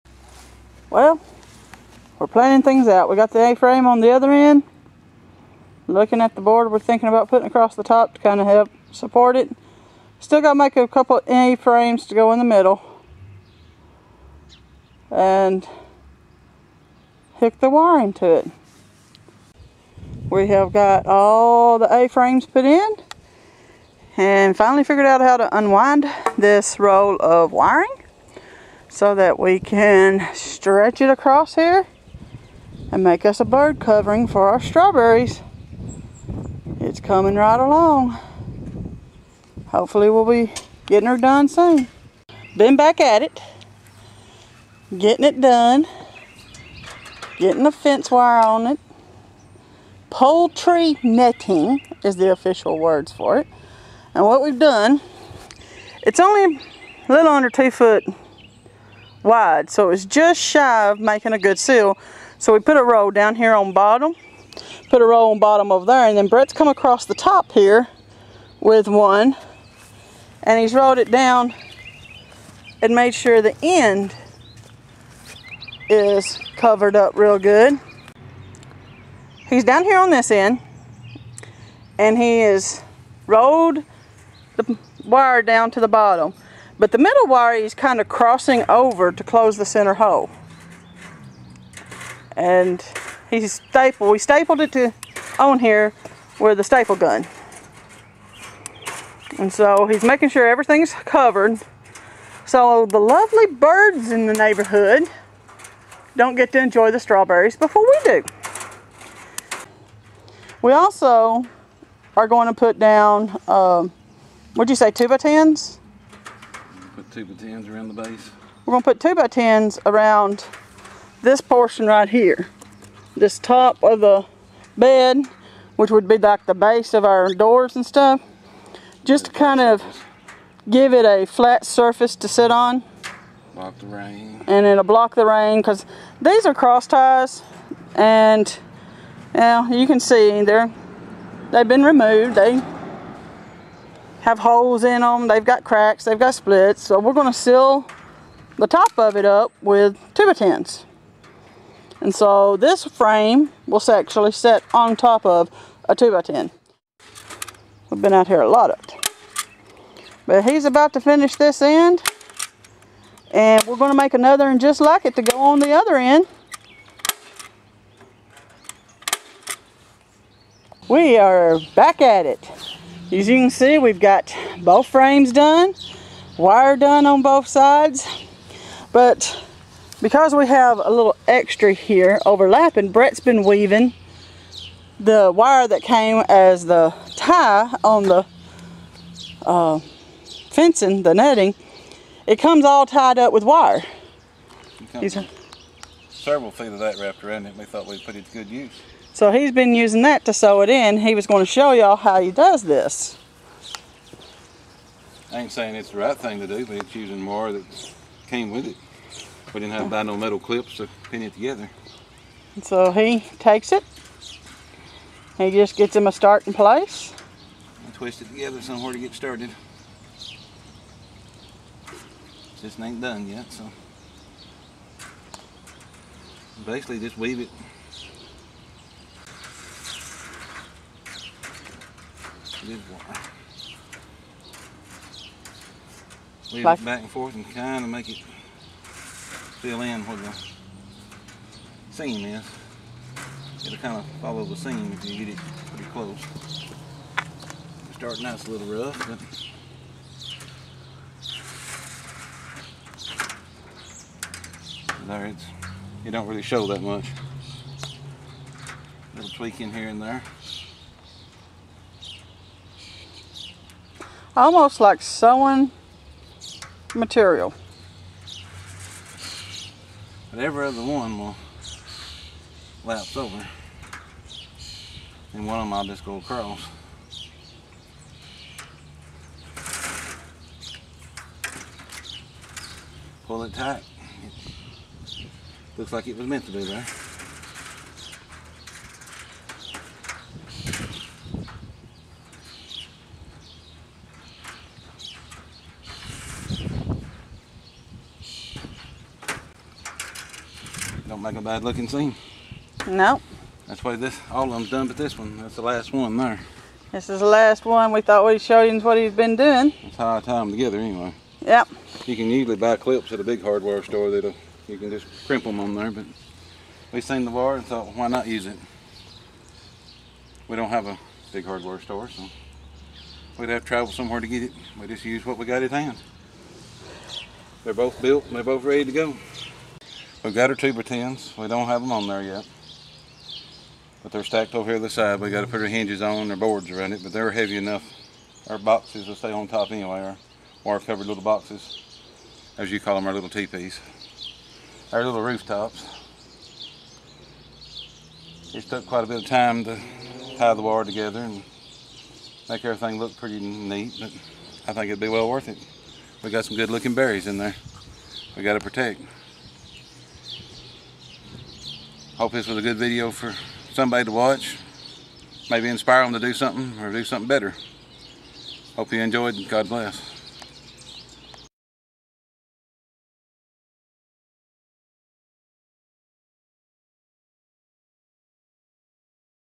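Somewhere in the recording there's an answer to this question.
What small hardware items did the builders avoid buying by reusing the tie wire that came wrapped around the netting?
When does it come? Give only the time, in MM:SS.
03:30.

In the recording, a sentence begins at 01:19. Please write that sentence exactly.
He's down here on this end, and he is rolled the wire down to the bottom.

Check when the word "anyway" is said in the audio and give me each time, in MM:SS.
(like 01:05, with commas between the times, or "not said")
05:10, 05:39.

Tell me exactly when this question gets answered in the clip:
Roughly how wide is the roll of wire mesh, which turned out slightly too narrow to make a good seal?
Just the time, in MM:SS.
00:57.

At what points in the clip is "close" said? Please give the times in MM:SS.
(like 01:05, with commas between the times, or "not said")
01:29, 04:05.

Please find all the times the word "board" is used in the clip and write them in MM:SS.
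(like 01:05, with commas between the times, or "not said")
00:06, 05:36.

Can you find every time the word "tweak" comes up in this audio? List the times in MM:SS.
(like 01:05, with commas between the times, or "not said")
04:19.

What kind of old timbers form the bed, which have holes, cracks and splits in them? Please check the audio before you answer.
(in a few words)
Cross ties.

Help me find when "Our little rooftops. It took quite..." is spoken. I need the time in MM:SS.
05:44.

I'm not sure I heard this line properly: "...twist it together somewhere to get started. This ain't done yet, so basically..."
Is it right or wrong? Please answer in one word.
right.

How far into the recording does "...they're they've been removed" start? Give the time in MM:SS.
02:20.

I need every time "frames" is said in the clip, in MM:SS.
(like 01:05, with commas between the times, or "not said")
00:03, 00:11, 00:21, 02:32, 02:54.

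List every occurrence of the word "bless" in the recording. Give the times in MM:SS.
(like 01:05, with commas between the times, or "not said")
06:09.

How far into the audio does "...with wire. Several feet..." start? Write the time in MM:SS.
03:13.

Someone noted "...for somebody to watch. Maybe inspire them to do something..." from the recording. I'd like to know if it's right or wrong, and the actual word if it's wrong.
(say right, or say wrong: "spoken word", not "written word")
right.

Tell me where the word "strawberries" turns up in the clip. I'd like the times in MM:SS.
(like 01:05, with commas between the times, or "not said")
00:34, 01:46.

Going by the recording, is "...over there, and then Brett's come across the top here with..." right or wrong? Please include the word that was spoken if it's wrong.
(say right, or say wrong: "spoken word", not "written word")
right.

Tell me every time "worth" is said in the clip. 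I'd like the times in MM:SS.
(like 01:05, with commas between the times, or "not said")
05:55.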